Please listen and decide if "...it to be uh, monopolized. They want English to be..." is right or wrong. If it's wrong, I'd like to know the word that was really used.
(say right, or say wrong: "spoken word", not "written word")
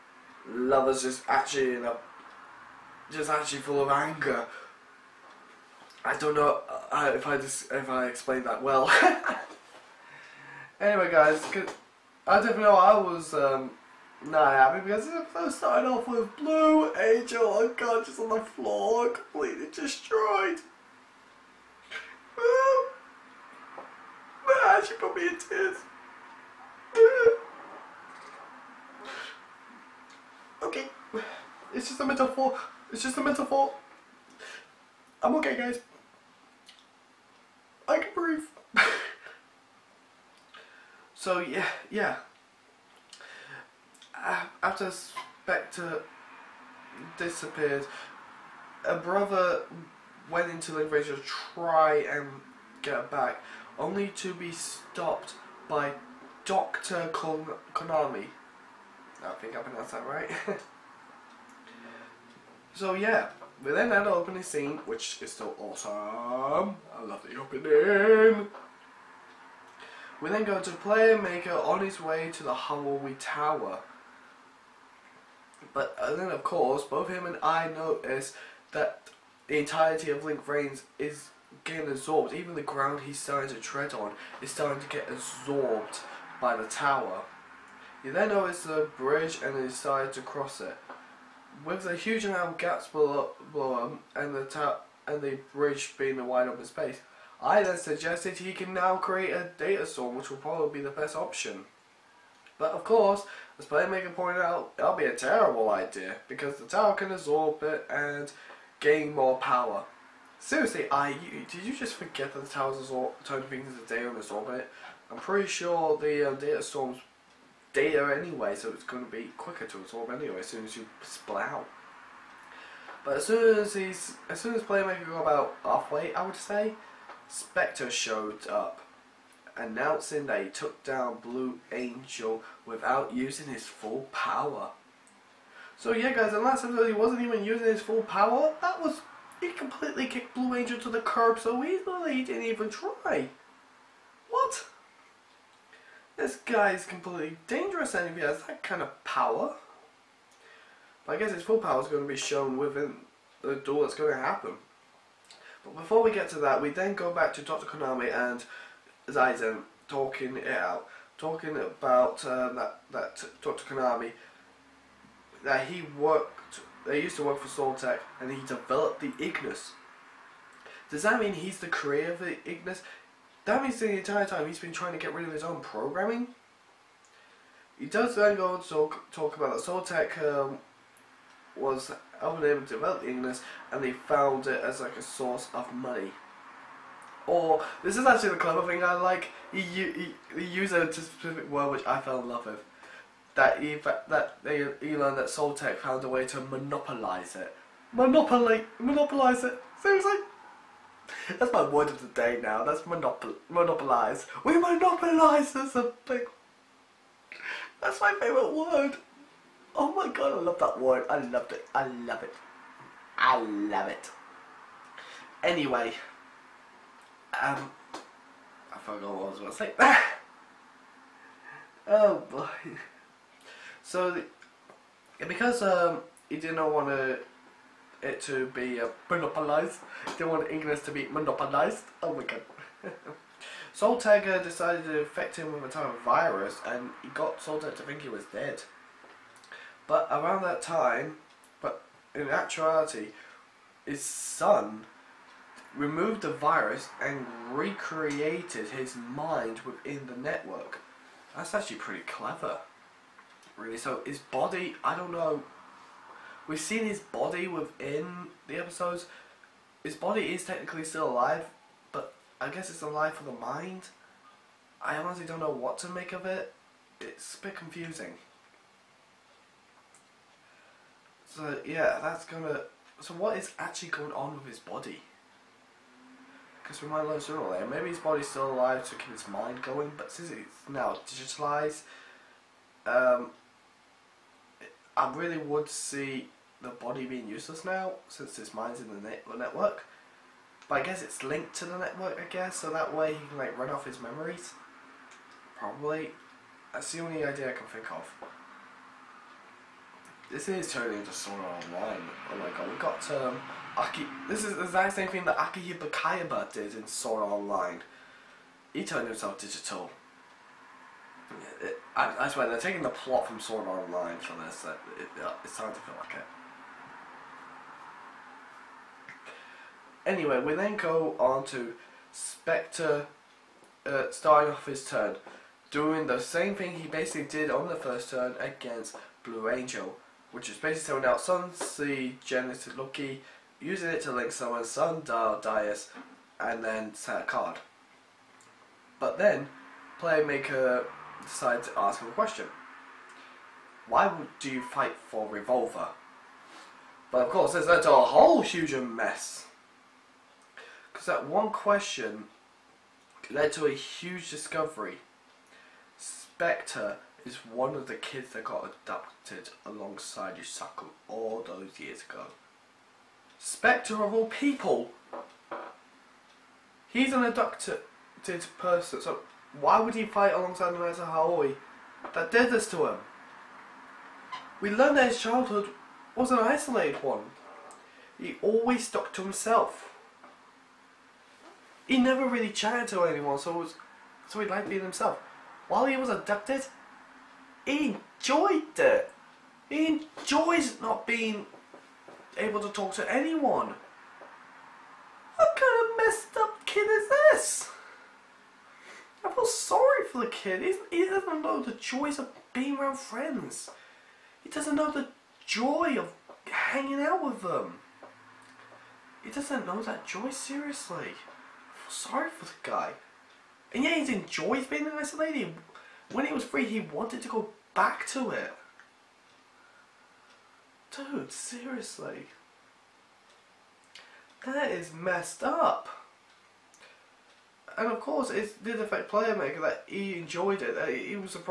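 right.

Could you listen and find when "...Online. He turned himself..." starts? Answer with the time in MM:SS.
05:07.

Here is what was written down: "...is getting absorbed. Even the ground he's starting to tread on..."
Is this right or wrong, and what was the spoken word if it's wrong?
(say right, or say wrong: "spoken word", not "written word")
right.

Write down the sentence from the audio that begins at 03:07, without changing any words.
Or, this is actually the clever thing I like, he, he, he used a specific word which I fell in love with.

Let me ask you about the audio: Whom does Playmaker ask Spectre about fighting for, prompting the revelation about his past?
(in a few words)
Revolver.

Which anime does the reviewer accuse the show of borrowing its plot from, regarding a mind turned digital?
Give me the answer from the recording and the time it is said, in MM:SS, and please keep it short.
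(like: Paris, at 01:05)
Sword Art Online, at 05:13.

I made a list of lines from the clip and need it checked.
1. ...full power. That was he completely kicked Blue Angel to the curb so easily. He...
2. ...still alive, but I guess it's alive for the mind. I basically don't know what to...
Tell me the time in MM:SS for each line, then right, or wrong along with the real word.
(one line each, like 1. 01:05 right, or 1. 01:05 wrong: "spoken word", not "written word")
1. 02:17 right
2. 04:20 wrong: "honestly", not "basically".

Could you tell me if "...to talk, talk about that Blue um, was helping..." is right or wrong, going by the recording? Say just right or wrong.
wrong.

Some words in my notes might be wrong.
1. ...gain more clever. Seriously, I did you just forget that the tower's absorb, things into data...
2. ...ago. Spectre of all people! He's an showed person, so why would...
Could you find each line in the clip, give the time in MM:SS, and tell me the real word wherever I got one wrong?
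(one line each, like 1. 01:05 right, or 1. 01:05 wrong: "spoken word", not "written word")
1. 01:48 wrong: "power", not "clever"
2. 06:02 wrong: "abducted", not "showed".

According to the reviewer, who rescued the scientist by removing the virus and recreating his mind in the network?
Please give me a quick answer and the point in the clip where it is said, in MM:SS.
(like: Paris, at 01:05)
His son, at 04:04.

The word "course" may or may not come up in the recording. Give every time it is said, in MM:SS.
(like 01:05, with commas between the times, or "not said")
01:16, 01:42, 05:47, 07:08.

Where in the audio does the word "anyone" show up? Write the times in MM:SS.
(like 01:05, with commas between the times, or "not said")
06:23, 06:33.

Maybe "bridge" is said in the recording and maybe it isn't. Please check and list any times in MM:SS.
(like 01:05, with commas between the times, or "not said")
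01:28, 01:35.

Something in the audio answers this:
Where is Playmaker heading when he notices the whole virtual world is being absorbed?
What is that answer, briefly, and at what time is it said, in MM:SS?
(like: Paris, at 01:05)
Halloween Tower, at 01:12.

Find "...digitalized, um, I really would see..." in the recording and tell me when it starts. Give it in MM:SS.
04:41.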